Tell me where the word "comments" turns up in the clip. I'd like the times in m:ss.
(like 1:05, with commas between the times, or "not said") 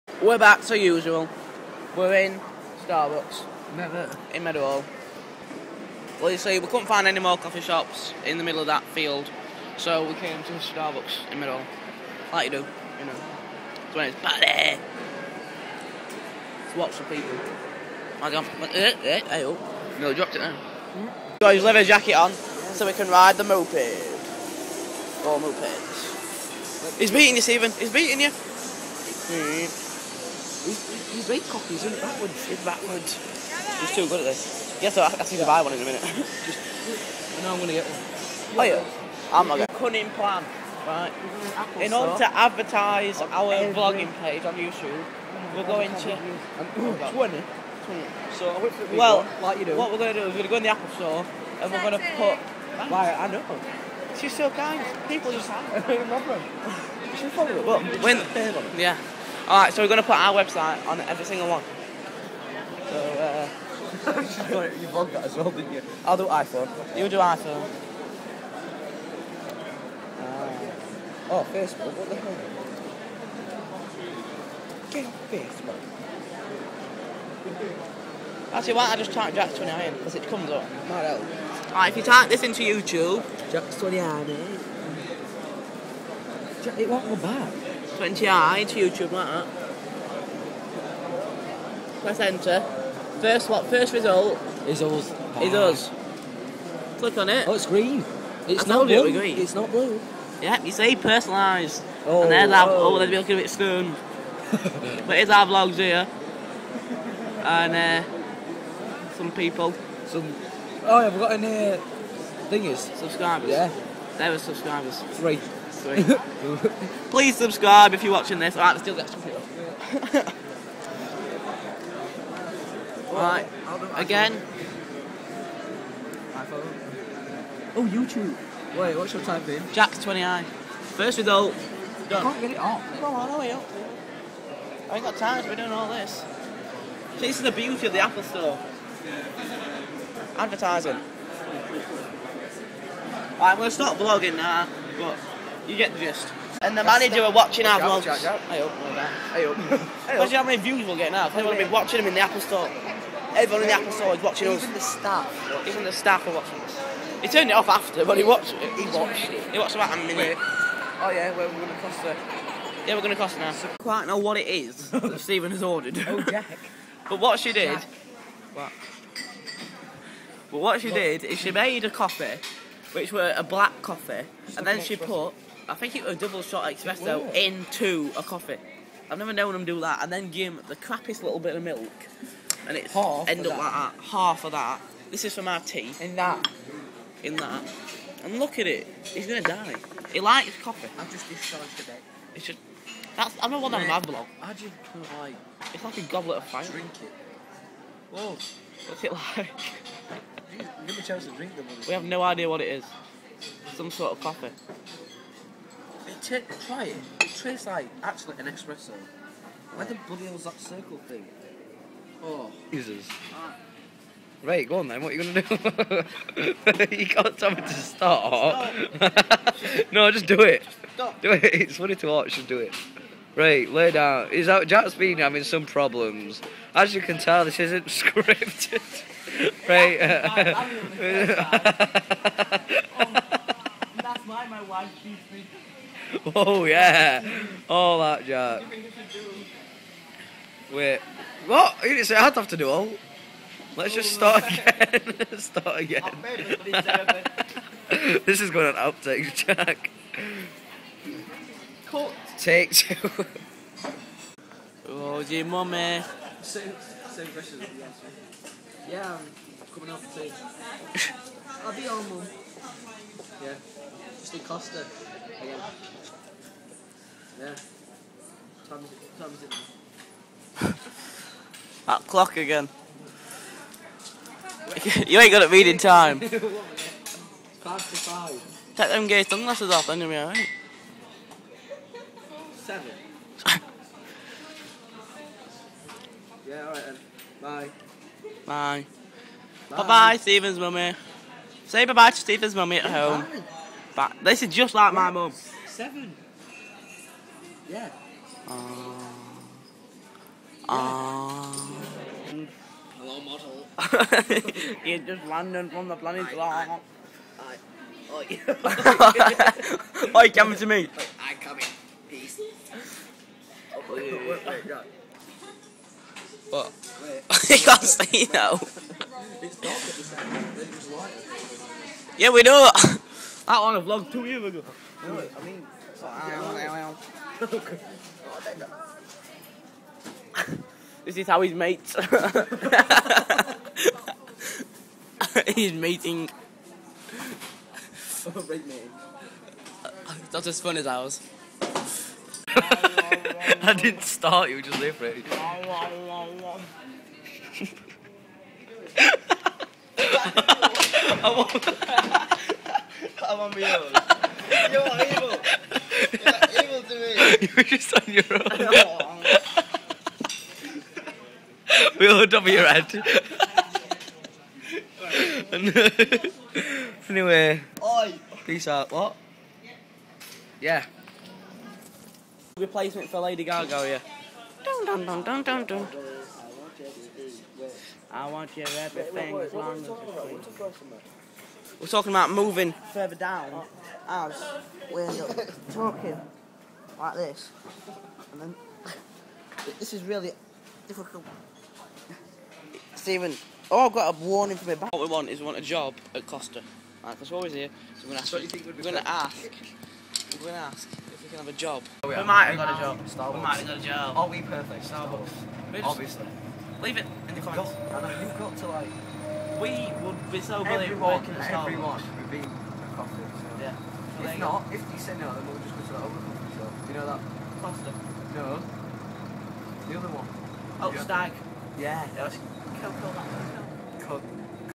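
6:47.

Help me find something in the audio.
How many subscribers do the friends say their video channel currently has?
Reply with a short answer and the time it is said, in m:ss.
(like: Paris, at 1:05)
3, at 1:55.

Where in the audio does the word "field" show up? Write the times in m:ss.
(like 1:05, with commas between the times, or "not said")
0:08.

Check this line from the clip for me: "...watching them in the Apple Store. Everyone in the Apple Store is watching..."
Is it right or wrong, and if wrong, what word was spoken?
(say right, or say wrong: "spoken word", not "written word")
right.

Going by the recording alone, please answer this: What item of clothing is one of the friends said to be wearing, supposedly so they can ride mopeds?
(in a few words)
Leather jacket.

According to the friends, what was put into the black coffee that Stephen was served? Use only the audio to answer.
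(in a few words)
Double shot espresso.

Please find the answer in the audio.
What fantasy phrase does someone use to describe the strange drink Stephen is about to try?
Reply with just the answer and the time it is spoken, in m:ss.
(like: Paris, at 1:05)
Goblet of fire, at 3:16.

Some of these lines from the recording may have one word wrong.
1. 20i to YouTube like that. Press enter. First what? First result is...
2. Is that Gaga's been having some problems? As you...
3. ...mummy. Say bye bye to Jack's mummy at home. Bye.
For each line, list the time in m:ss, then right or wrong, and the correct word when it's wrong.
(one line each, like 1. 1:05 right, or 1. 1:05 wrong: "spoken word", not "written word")
1. 1:28 right
2. 3:44 wrong: "Jack", not "Gaga"
3. 4:50 wrong: "Stephen", not "Jack".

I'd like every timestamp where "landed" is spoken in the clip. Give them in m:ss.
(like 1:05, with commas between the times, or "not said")
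5:05.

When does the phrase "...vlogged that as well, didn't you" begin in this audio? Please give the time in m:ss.
1:04.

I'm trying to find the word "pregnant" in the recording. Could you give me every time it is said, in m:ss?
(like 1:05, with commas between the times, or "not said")
not said.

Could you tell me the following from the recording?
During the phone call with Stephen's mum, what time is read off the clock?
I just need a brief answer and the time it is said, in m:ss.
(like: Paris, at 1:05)
Five to five, at 4:36.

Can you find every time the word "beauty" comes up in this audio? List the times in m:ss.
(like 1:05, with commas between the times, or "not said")
2:17.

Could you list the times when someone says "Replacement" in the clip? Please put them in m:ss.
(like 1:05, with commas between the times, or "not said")
6:12.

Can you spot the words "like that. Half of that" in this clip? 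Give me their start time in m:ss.
3:03.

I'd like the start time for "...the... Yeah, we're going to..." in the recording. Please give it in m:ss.
2:42.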